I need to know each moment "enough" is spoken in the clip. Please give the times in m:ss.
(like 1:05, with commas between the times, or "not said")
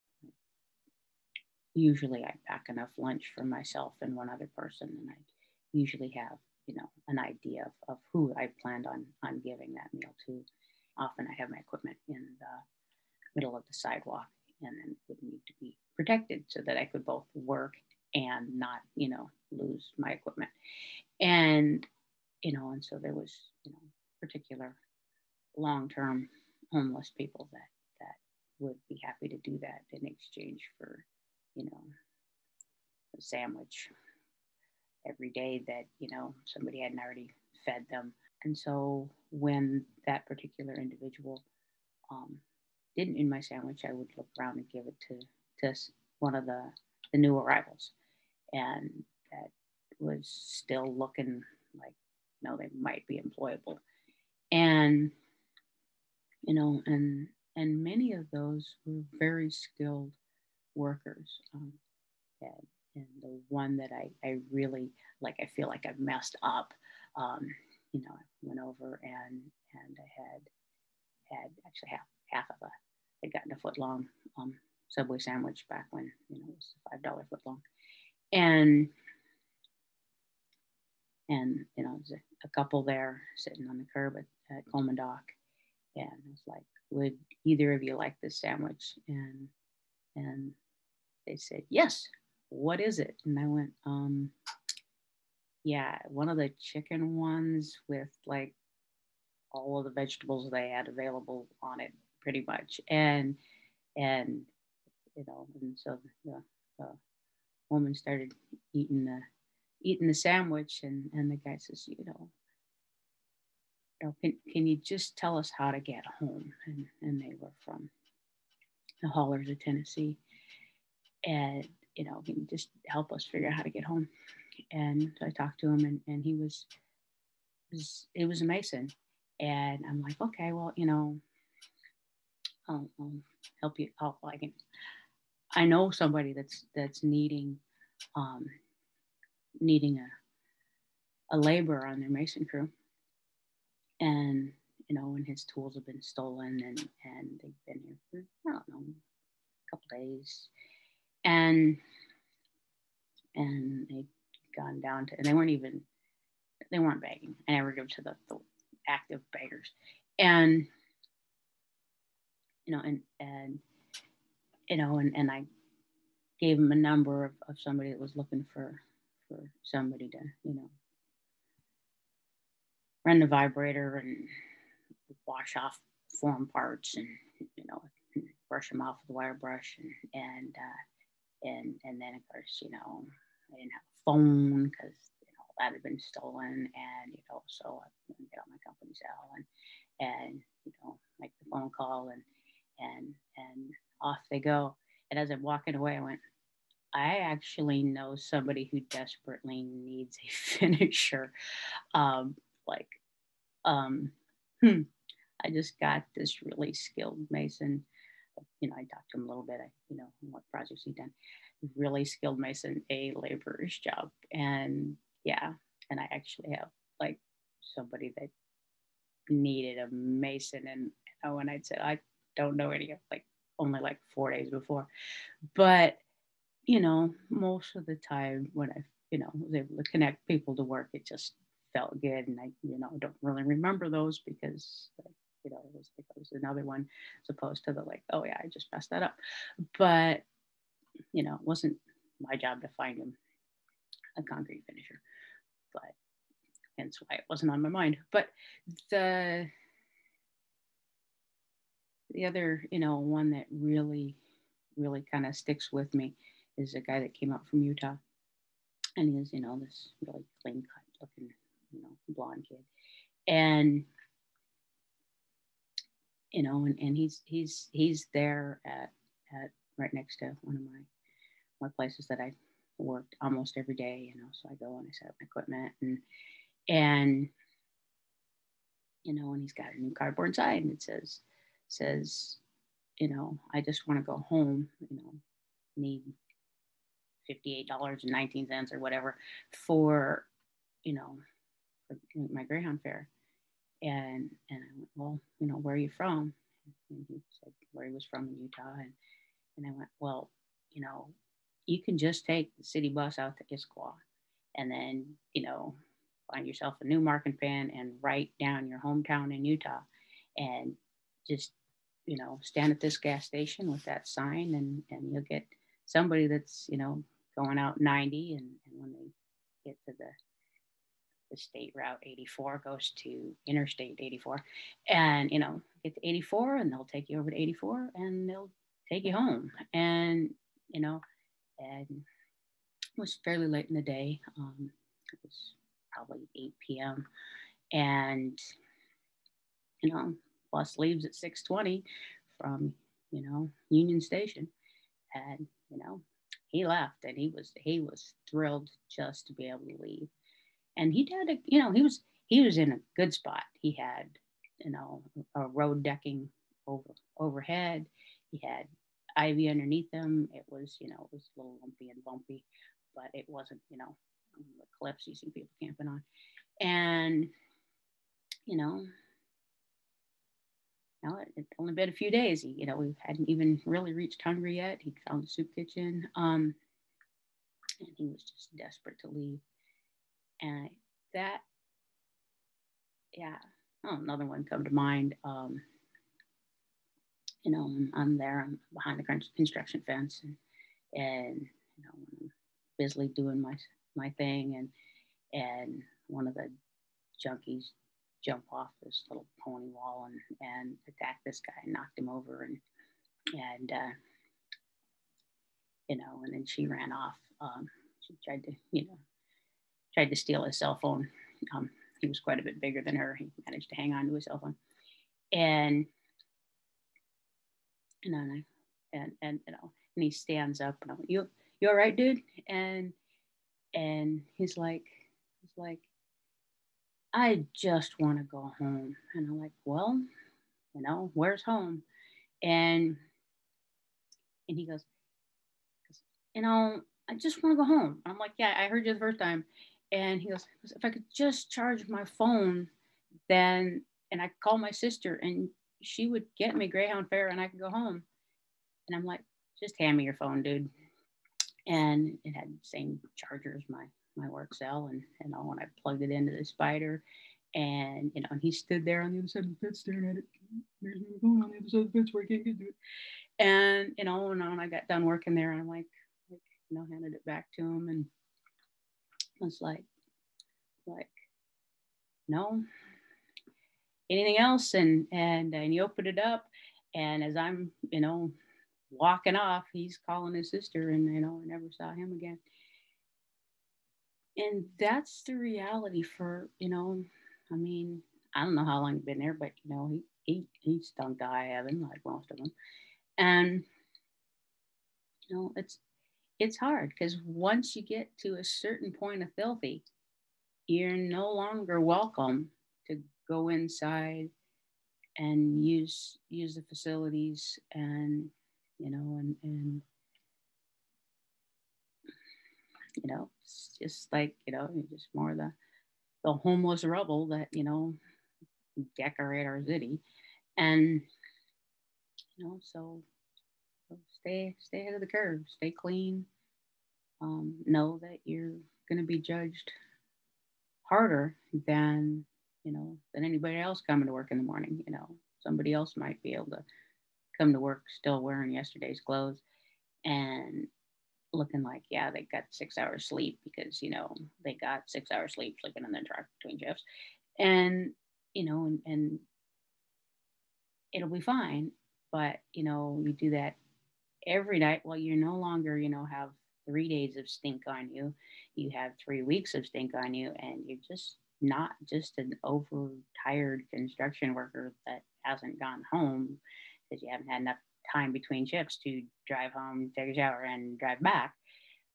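0:02, 9:27.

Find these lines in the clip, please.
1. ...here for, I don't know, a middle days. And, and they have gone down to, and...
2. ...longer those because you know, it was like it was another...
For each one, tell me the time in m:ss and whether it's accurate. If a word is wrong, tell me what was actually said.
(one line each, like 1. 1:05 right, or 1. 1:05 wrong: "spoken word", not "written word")
1. 2:27 wrong: "couple", not "middle"
2. 3:53 wrong: "remember", not "longer".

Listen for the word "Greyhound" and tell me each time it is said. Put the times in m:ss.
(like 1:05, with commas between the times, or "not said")
4:52, 7:26.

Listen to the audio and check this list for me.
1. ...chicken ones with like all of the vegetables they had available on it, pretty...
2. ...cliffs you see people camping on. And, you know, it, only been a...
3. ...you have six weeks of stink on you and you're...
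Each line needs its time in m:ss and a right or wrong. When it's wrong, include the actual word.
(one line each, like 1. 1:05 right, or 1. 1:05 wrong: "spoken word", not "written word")
1. 1:36 right
2. 6:04 right
3. 9:18 wrong: "three", not "six".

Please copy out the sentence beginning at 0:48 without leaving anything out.
And that was still looking like, you know, they might be employable.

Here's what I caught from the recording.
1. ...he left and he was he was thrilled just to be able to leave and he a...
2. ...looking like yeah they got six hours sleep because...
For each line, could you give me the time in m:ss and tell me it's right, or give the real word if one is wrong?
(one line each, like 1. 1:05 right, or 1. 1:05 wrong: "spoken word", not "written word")
1. 5:46 right
2. 9:01 right.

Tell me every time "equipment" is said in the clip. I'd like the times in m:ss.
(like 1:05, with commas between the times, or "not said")
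0:11, 0:20, 4:35.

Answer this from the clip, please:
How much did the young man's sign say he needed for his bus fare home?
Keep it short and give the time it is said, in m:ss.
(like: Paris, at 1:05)
$58.19, at 4:47.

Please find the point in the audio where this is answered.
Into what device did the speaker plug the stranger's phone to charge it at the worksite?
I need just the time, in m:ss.
7:36.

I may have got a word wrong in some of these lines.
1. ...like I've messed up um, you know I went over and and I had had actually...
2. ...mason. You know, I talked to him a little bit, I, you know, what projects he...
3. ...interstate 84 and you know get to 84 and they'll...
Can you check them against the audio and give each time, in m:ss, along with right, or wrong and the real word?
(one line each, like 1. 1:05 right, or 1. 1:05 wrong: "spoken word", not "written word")
1. 1:05 right
2. 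3:27 right
3. 5:23 right.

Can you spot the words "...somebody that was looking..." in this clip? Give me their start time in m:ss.
2:47.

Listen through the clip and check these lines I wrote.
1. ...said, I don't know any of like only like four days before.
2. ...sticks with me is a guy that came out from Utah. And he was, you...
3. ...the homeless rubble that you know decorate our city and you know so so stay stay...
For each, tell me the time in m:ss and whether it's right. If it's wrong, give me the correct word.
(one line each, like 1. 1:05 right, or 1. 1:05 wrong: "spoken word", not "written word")
1. 3:41 right
2. 4:15 right
3. 8:36 right.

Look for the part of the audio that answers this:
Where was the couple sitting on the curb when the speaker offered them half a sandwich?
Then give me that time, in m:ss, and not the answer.
1:24.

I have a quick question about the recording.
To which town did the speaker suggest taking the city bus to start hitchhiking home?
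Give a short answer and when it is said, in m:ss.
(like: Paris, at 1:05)
Issaquah, at 5:03.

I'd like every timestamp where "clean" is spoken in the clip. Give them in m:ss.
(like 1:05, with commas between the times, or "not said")
4:20, 8:45.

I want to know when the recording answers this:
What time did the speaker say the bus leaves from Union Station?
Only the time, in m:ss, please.
5:41.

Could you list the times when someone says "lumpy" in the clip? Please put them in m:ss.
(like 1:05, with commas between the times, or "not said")
6:01.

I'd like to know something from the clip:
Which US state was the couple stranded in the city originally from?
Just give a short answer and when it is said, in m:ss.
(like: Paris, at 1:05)
Tennessee, at 1:59.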